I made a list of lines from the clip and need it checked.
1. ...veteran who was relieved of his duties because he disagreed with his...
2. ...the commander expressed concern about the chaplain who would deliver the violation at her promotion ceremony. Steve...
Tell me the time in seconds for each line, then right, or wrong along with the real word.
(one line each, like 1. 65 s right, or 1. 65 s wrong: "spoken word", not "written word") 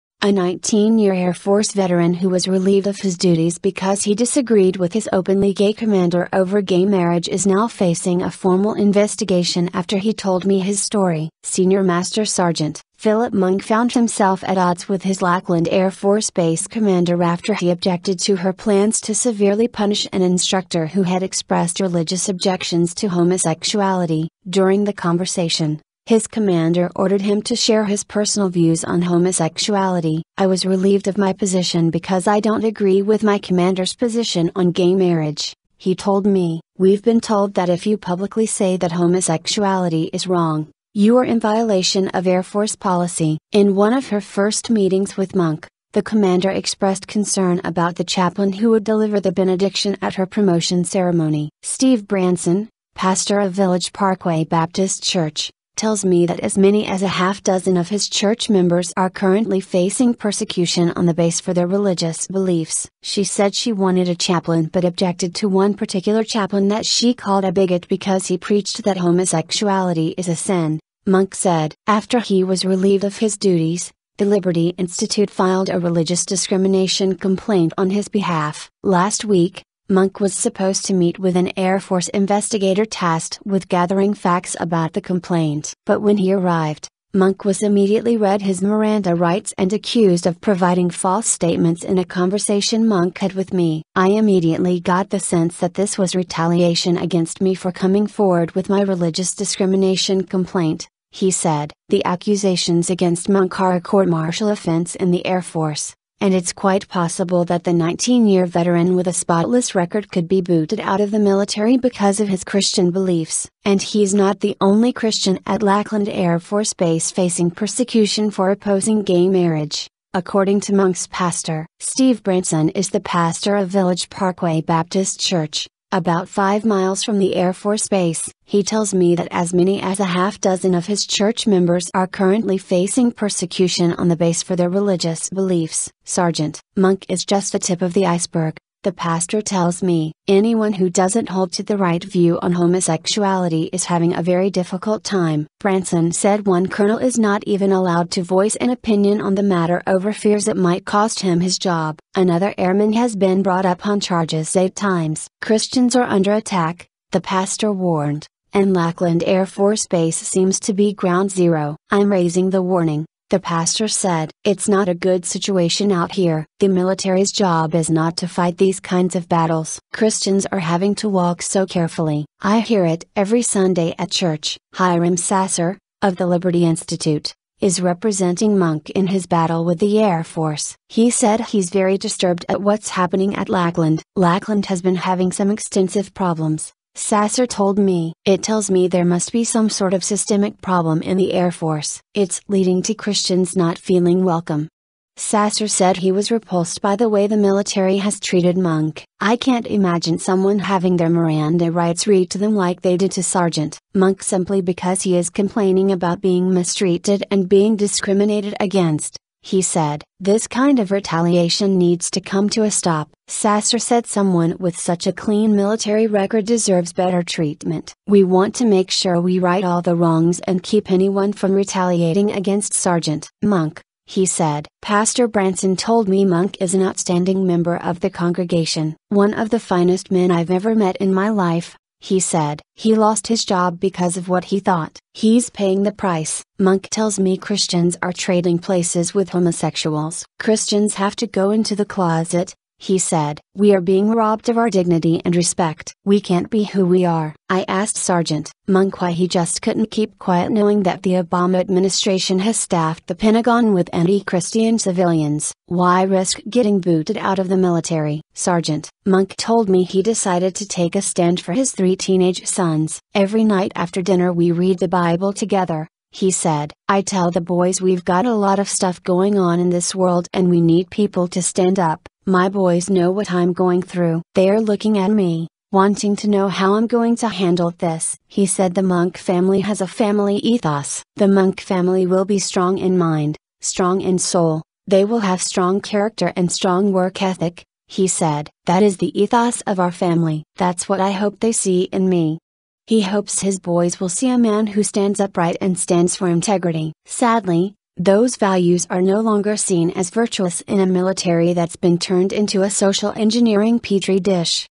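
1. 1 s right
2. 45 s wrong: "benediction", not "violation".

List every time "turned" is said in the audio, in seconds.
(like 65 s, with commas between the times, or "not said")
301 s.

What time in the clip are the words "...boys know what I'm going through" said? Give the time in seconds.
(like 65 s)
272 s.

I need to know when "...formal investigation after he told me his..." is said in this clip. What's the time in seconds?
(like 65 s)
8 s.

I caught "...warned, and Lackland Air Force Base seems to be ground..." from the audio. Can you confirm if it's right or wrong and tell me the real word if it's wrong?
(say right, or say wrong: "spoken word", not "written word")
right.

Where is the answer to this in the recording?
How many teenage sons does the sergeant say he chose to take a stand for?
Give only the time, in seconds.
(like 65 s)
261 s.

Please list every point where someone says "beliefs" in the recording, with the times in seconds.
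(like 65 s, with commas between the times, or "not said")
62 s, 112 s, 135 s.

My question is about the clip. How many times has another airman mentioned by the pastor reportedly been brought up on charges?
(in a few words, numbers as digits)
8.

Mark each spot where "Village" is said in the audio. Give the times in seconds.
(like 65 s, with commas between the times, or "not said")
53 s, 123 s.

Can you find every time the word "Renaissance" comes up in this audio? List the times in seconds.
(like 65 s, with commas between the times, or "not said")
not said.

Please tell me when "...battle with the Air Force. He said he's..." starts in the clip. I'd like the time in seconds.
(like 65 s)
179 s.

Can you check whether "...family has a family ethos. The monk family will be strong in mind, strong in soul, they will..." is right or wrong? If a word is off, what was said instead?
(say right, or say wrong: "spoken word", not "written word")
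right.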